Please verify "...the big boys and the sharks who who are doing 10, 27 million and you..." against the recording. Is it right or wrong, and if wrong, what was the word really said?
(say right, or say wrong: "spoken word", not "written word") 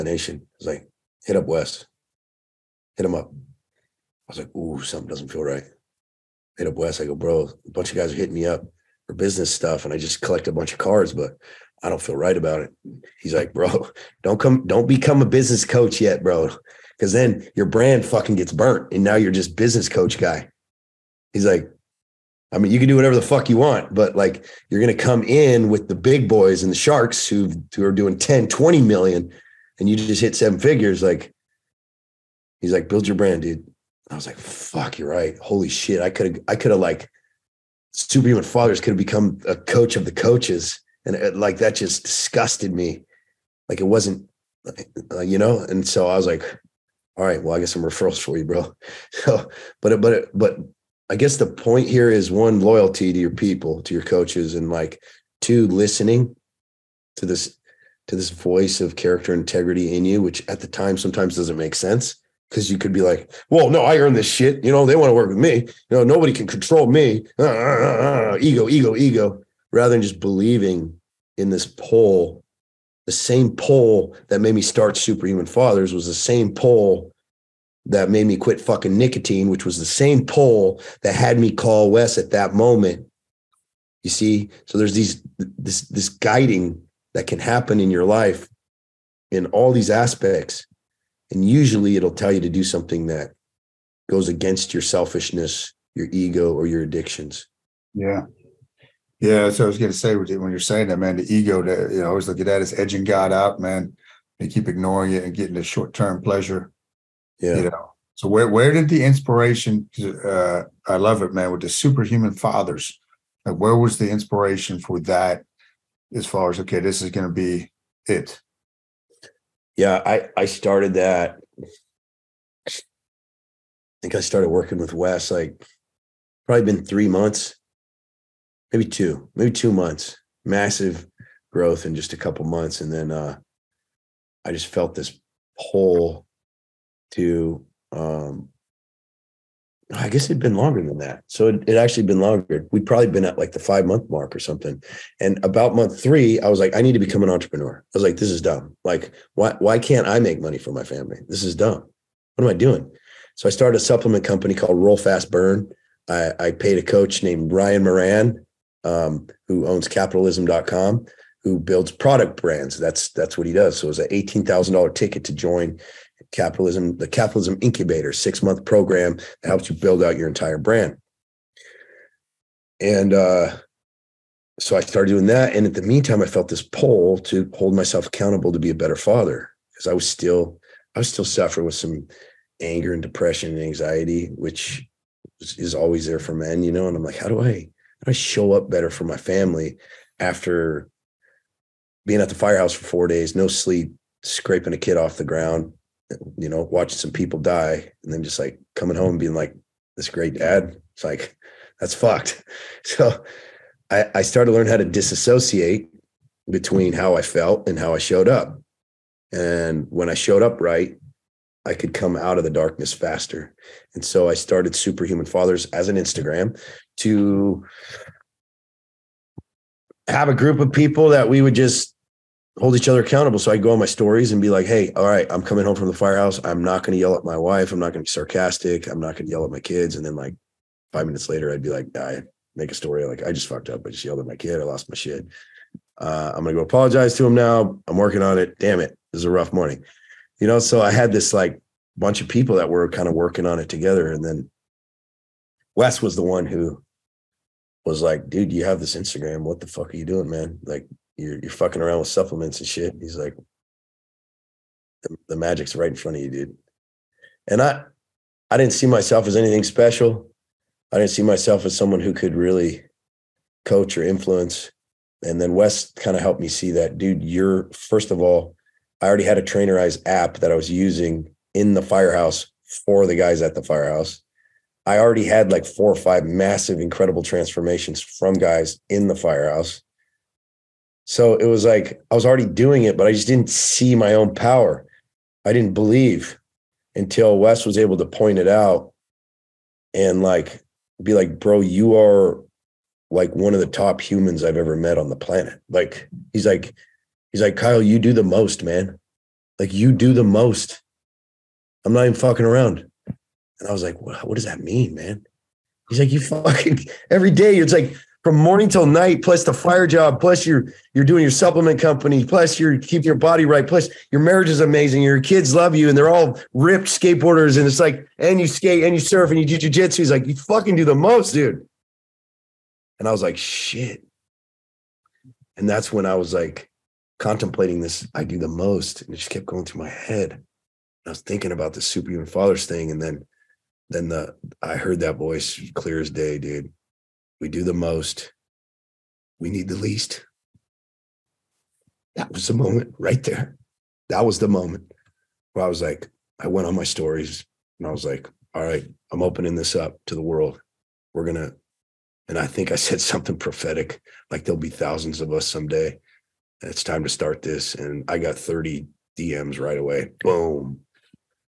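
wrong: "20", not "27".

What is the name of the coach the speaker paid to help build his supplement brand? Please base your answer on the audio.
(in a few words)
Ryan Moran.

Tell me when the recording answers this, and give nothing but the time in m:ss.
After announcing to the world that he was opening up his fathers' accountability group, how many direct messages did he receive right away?
5:58.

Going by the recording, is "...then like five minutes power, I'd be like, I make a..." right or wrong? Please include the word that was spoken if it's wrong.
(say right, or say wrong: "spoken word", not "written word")
wrong: "later", not "power".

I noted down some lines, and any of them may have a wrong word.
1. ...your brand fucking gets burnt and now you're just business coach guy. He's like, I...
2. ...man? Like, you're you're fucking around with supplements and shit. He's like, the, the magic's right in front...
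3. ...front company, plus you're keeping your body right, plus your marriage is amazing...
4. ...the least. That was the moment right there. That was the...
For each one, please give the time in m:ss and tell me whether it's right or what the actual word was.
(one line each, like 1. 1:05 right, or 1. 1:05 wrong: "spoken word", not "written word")
1. 0:17 right
2. 4:10 right
3. 5:11 wrong: "supplement", not "front"
4. 5:39 right.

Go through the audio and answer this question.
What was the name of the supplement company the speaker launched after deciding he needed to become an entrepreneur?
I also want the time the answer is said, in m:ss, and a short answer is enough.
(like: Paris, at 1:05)
Roll Fast Burn, at 2:34.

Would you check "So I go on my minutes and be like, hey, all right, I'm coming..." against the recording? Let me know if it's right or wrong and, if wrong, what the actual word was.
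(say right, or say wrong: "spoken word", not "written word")
wrong: "stories", not "minutes".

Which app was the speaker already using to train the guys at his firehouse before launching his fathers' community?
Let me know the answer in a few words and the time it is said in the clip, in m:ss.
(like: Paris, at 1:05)
Trainerize, at 4:29.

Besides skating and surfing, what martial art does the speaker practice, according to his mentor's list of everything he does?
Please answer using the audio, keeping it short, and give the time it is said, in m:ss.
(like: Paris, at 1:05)
Jujitsu, at 5:19.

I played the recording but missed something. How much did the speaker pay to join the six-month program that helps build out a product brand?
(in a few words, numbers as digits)
$18,000.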